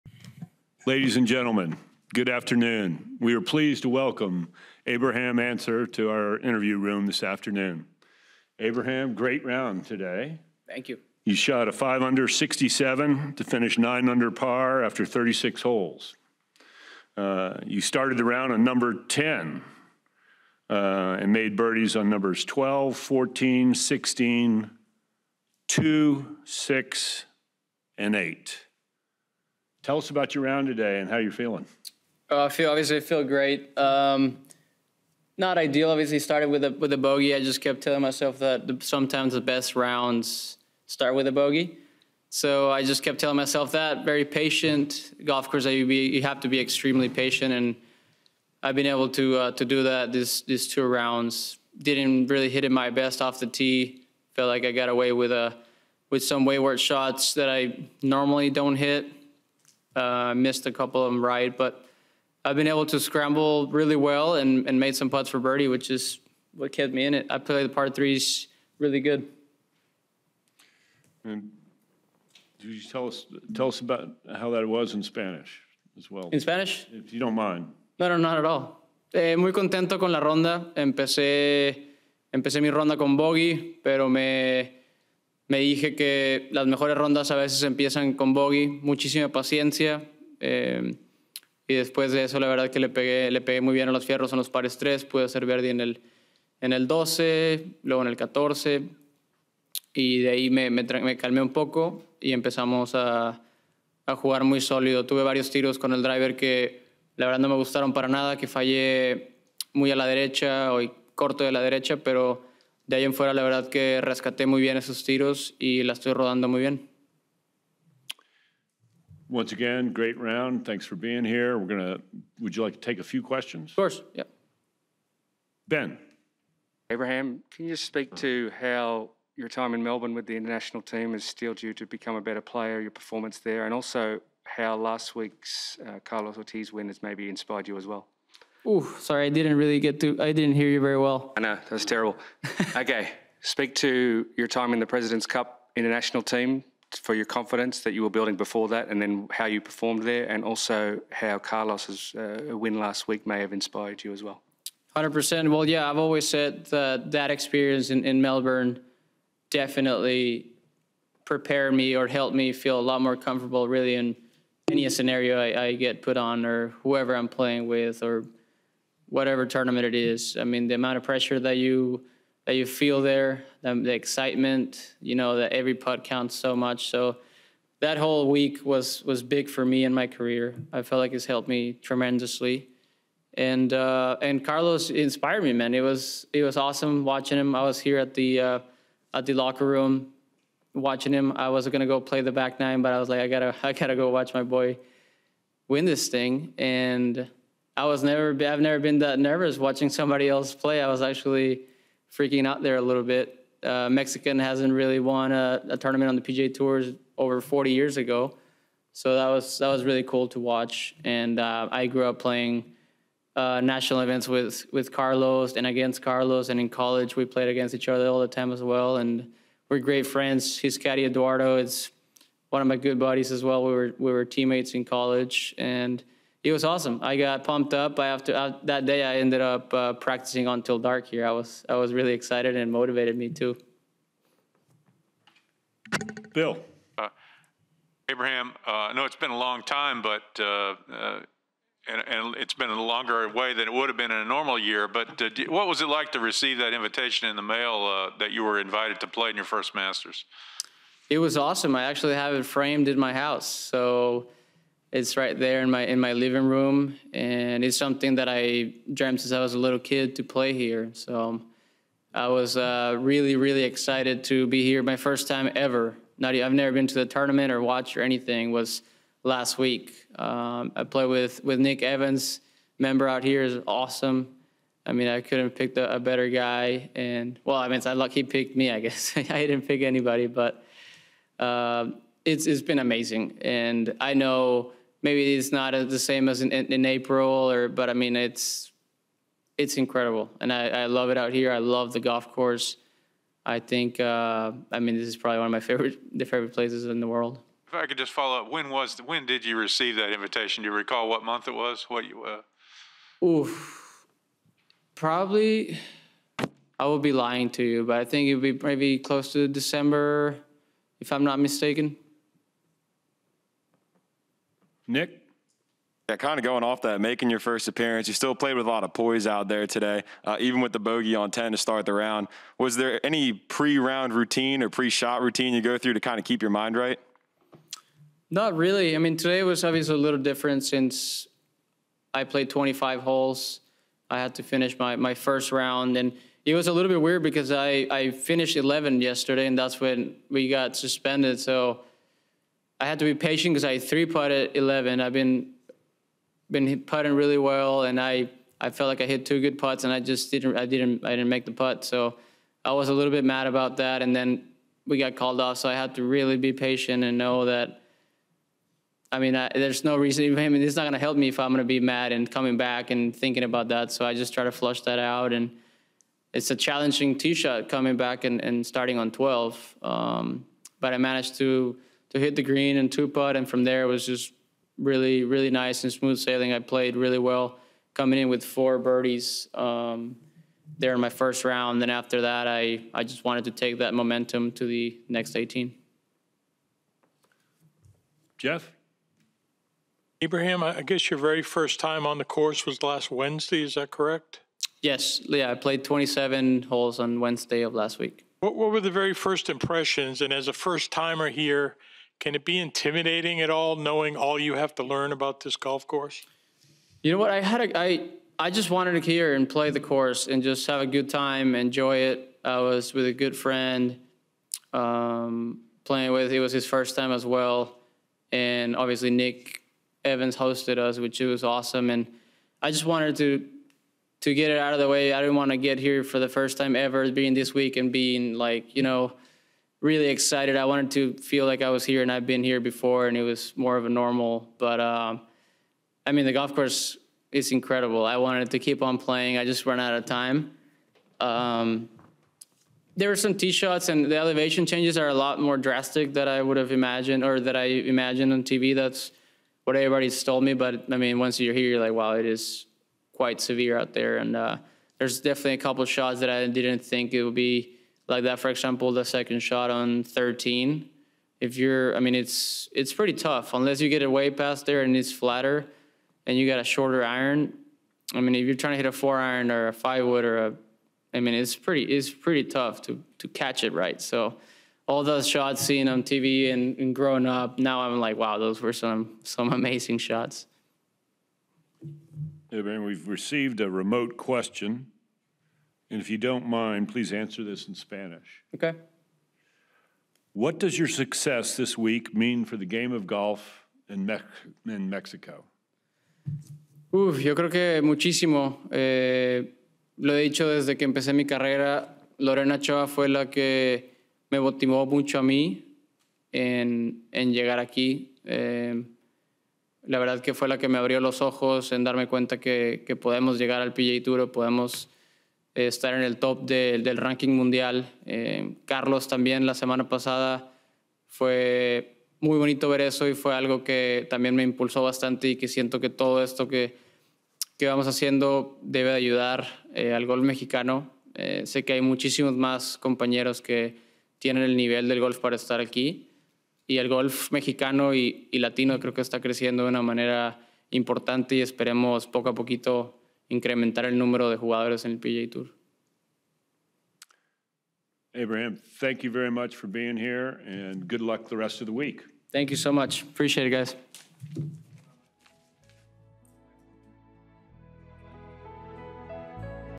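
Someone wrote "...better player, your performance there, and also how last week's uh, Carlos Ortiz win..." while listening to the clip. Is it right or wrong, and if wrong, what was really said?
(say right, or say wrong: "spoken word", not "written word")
right.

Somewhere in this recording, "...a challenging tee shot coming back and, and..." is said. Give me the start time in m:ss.
6:06.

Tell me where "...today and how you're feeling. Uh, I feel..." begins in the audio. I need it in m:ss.
0:30.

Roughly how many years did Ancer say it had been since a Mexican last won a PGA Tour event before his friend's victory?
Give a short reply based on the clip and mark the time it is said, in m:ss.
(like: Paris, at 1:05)
40, at 3:27.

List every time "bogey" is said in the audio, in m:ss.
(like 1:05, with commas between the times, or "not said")
0:36, 0:41, 1:23, 1:28, 5:20.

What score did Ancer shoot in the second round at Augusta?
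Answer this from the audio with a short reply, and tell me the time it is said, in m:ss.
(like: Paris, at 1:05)
67, at 0:12.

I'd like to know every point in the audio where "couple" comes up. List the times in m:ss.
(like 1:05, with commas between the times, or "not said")
1:00, 7:35.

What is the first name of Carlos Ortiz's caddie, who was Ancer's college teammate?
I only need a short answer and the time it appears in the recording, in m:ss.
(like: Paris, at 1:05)
Eduardo, at 3:41.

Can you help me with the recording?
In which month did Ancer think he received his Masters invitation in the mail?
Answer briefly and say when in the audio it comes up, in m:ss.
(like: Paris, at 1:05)
December, at 5:09.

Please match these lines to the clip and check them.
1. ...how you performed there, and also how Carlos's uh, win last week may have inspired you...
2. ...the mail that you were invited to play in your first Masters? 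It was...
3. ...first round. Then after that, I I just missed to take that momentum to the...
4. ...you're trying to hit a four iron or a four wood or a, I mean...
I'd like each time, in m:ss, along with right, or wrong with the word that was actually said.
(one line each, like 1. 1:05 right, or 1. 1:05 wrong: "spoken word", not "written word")
1. 2:29 right
2. 4:07 right
3. 6:21 wrong: "wanted", not "missed"
4. 7:48 wrong: "five", not "four".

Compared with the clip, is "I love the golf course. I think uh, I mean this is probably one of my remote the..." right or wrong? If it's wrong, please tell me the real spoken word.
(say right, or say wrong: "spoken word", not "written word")
wrong: "favorite", not "remote".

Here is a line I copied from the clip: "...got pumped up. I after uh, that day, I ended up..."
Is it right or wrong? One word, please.
right.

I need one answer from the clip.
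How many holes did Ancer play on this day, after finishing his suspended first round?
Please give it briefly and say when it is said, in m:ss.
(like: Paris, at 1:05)
25, at 5:32.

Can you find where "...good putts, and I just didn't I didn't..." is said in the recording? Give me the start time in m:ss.
5:49.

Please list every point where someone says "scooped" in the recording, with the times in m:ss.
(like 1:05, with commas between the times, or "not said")
not said.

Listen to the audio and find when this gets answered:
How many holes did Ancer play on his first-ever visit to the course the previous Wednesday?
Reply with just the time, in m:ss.
6:35.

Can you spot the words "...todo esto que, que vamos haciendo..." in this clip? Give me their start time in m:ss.
8:45.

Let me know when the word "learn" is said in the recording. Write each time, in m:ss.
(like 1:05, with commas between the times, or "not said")
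6:44.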